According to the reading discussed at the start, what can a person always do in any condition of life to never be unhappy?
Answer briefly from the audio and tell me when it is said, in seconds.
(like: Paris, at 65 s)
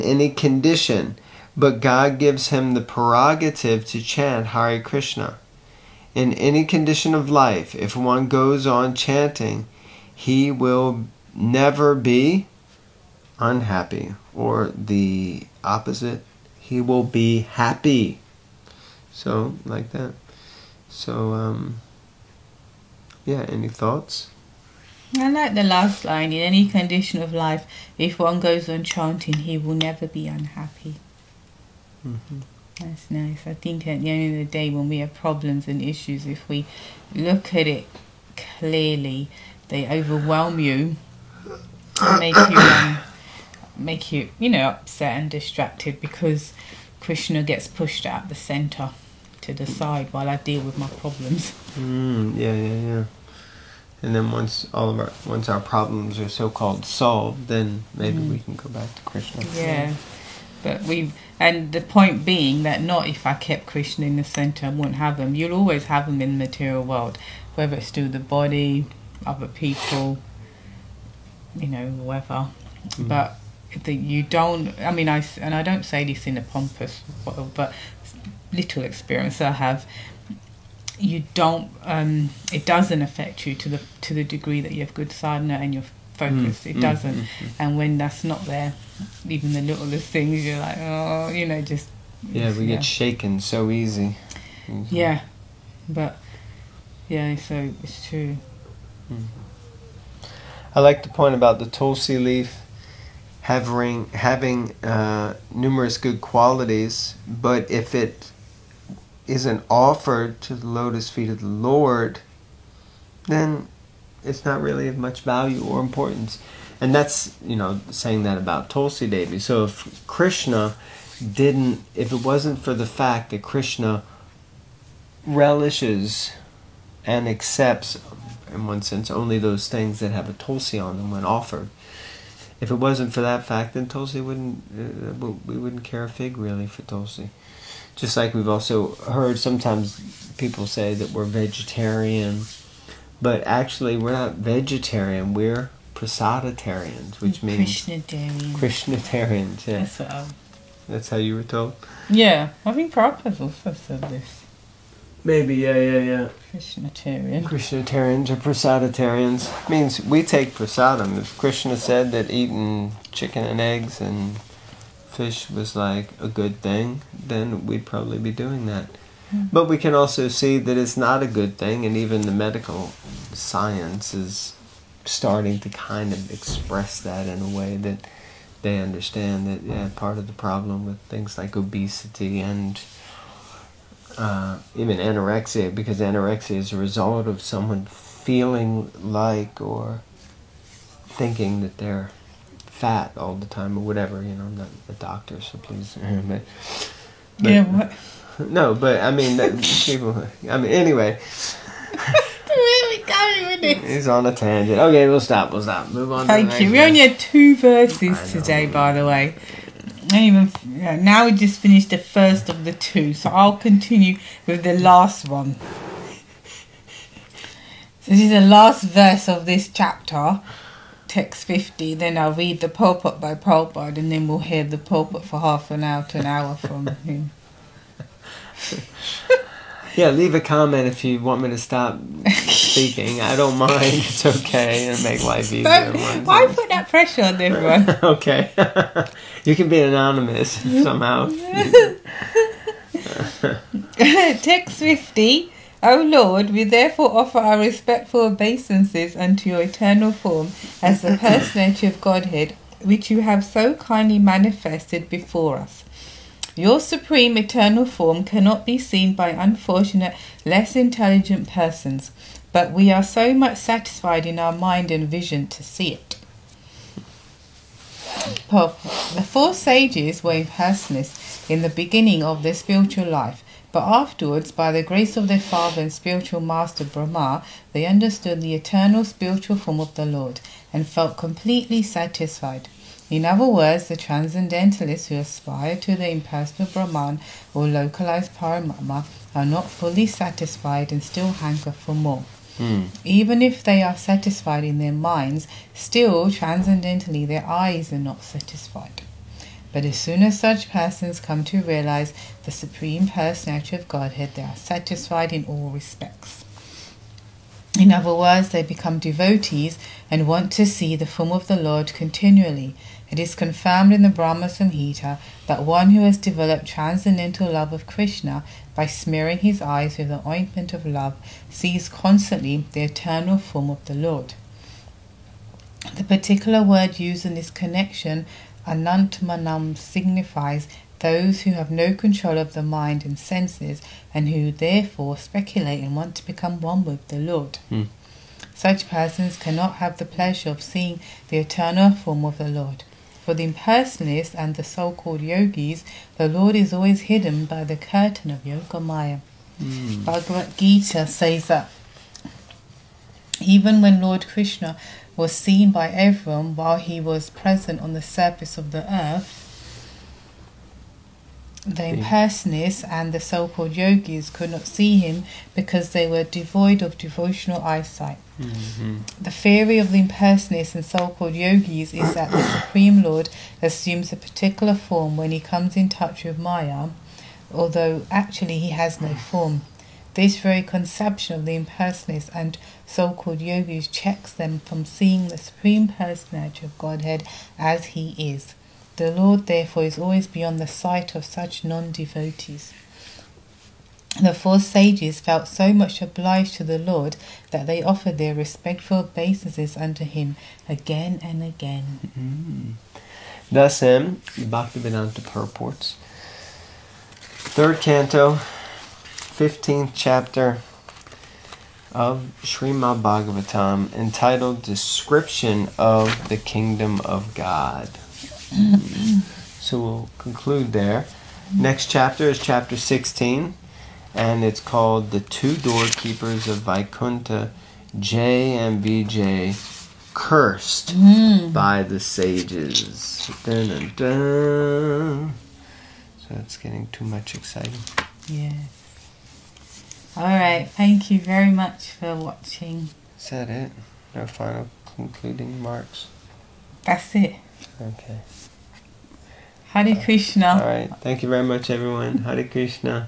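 Chant Hare Krishna, at 4 s.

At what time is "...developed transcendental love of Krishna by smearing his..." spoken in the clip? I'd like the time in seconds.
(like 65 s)
316 s.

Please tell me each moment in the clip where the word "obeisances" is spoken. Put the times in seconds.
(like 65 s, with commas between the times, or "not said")
248 s, 398 s.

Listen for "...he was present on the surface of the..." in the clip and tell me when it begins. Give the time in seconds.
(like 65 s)
356 s.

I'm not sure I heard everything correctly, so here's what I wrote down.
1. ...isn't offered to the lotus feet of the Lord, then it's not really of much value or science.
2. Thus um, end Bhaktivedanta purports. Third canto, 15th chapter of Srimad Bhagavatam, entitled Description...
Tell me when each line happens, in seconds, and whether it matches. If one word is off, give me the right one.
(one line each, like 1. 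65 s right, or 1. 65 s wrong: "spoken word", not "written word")
1. 109 s wrong: "importance", not "science"
2. 403 s right.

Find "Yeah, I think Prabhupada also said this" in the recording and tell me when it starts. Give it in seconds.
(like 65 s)
152 s.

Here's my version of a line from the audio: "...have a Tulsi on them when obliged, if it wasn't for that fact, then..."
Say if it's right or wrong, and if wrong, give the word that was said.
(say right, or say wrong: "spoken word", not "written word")
wrong: "offered", not "obliged".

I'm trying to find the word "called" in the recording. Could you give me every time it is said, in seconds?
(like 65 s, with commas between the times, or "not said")
56 s, 344 s, 363 s, 371 s, 383 s, 424 s.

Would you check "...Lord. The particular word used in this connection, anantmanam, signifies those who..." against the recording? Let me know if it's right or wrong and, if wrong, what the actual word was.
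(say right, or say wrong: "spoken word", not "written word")
right.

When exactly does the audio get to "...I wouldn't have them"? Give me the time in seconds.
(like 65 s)
64 s.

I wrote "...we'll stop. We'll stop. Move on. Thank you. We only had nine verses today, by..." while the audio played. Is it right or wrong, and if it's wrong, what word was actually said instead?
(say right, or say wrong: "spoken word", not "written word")
wrong: "two", not "nine".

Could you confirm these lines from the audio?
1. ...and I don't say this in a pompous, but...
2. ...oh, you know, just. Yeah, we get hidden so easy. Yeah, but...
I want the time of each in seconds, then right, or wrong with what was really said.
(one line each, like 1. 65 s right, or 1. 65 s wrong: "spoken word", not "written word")
1. 75 s right
2. 90 s wrong: "shaken", not "hidden".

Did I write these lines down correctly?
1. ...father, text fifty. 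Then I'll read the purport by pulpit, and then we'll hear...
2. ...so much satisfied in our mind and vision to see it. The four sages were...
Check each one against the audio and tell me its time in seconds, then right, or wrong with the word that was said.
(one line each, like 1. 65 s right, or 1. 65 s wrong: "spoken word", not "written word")
1. 219 s wrong: "chapter", not "father"
2. 263 s right.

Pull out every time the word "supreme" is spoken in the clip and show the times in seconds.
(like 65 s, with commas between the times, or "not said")
256 s, 302 s, 372 s, 385 s.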